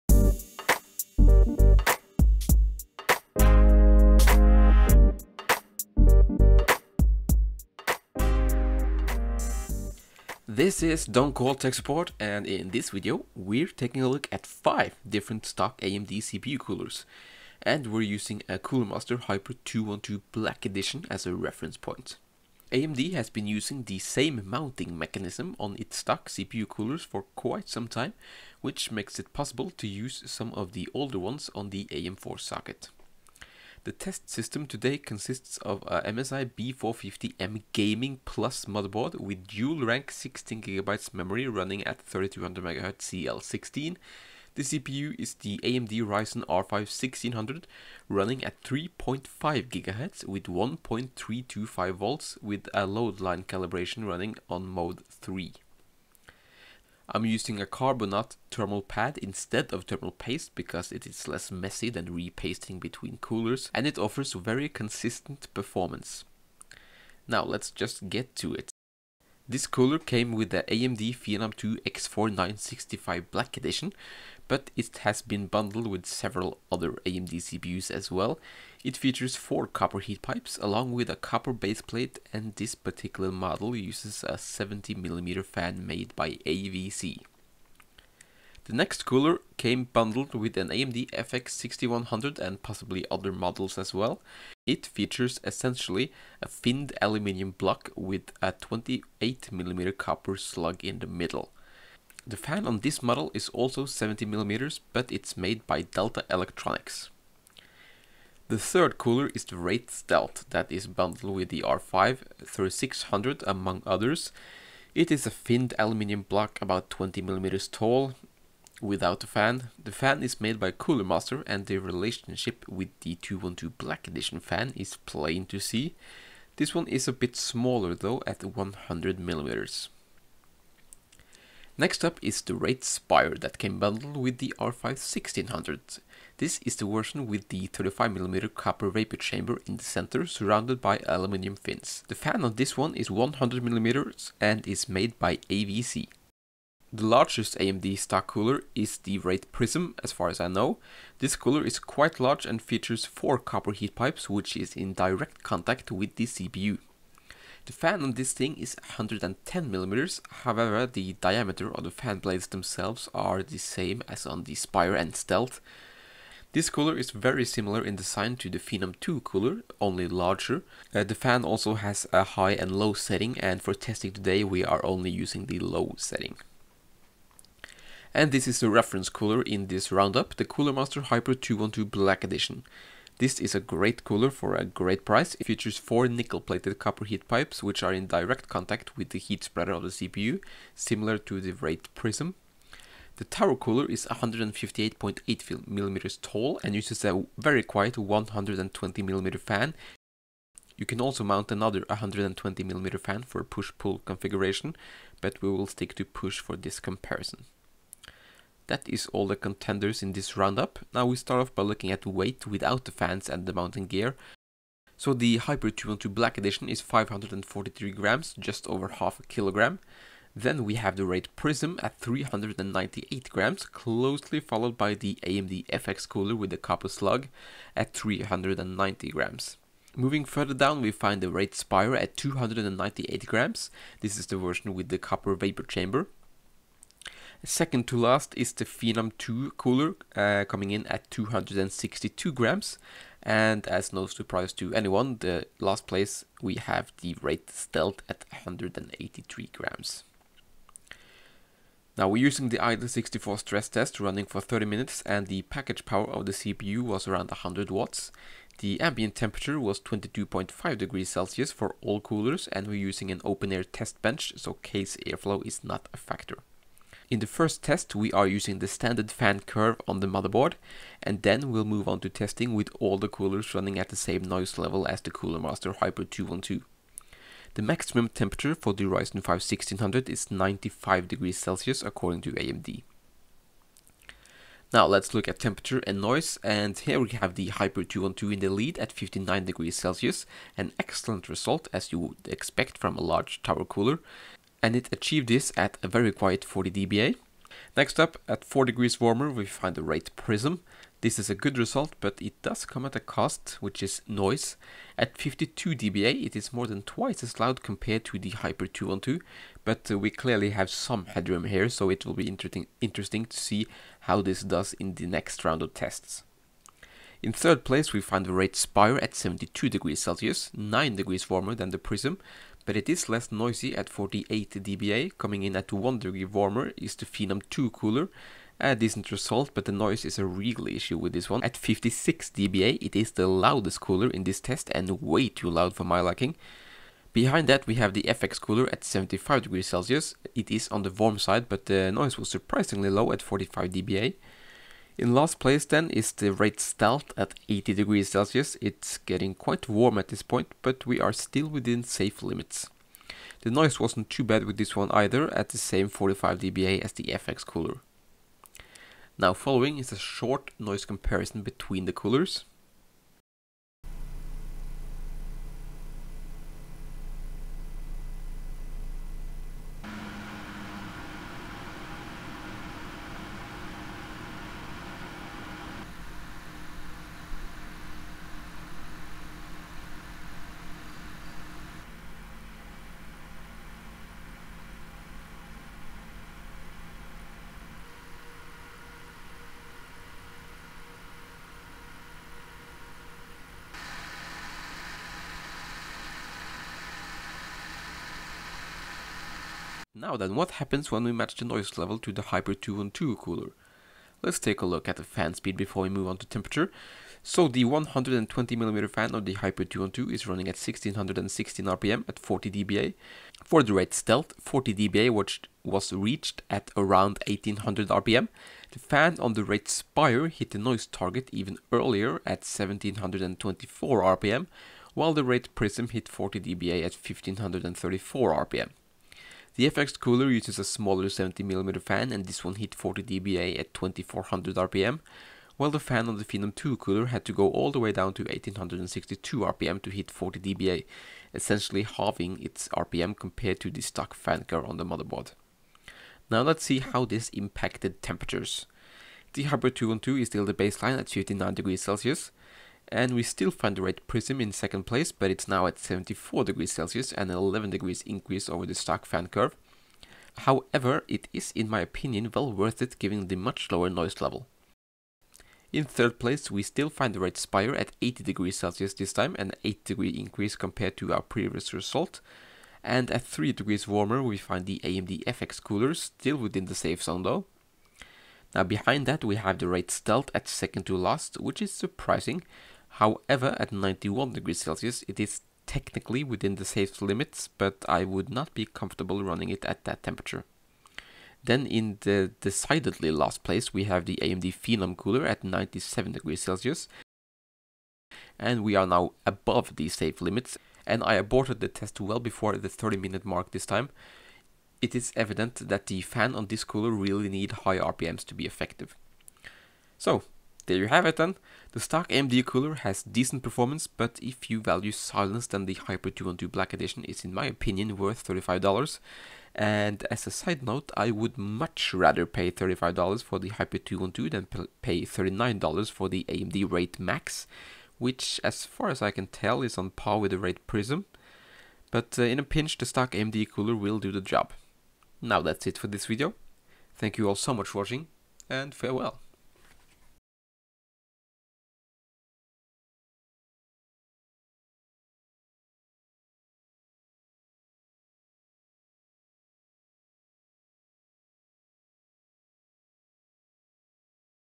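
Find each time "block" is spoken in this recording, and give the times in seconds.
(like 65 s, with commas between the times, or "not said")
97 s, 116 s.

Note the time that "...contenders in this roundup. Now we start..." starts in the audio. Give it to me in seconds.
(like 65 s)
209 s.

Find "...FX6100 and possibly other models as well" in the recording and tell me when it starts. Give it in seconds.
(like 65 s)
91 s.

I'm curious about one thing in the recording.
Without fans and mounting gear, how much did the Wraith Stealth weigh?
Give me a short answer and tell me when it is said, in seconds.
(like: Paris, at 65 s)
183 grams, at 248 s.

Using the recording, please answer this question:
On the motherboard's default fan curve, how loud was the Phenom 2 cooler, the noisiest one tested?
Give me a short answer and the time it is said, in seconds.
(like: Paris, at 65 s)
56 dBA, at 331 s.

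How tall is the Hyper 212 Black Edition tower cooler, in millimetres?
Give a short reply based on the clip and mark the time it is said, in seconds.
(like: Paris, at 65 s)
158.8 mm, at 194 s.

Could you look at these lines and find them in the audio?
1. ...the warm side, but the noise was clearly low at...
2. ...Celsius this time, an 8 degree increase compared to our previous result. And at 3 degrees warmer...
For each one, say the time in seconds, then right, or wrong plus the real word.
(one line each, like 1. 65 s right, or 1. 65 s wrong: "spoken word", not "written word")
1. 340 s wrong: "surprisingly", not "clearly"
2. 468 s right.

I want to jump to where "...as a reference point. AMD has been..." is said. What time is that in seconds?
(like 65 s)
21 s.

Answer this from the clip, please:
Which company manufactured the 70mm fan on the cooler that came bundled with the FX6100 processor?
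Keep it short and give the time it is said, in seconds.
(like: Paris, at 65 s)
Delta Electronics, at 105 s.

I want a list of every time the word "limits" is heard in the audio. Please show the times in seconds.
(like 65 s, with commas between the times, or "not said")
352 s, 487 s, 500 s.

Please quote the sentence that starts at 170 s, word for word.
Uh, the fan also has a high and low setting and for testing today we are only using the low setting.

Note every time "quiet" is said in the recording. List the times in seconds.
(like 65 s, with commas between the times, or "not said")
197 s, 296 s.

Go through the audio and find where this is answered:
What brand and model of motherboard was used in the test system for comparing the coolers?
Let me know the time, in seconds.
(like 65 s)
36 s.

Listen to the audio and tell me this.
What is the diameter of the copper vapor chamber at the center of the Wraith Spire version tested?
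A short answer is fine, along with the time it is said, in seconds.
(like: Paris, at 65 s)
35mm, at 137 s.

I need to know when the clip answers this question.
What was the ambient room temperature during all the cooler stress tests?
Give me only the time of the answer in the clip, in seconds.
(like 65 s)
259 s.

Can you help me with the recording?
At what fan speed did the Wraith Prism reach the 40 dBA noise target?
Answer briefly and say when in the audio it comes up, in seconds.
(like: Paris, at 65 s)
1534 RPM, at 426 s.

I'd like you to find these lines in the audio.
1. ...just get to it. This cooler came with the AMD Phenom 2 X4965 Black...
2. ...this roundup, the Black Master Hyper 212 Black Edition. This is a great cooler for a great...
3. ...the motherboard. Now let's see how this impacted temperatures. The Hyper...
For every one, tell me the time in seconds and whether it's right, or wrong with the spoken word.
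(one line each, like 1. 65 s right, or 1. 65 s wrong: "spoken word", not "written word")
1. 67 s right
2. 179 s wrong: "Cooler", not "Black"
3. 444 s right.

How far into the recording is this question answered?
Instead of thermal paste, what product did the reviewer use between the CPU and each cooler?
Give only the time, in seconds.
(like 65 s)
57 s.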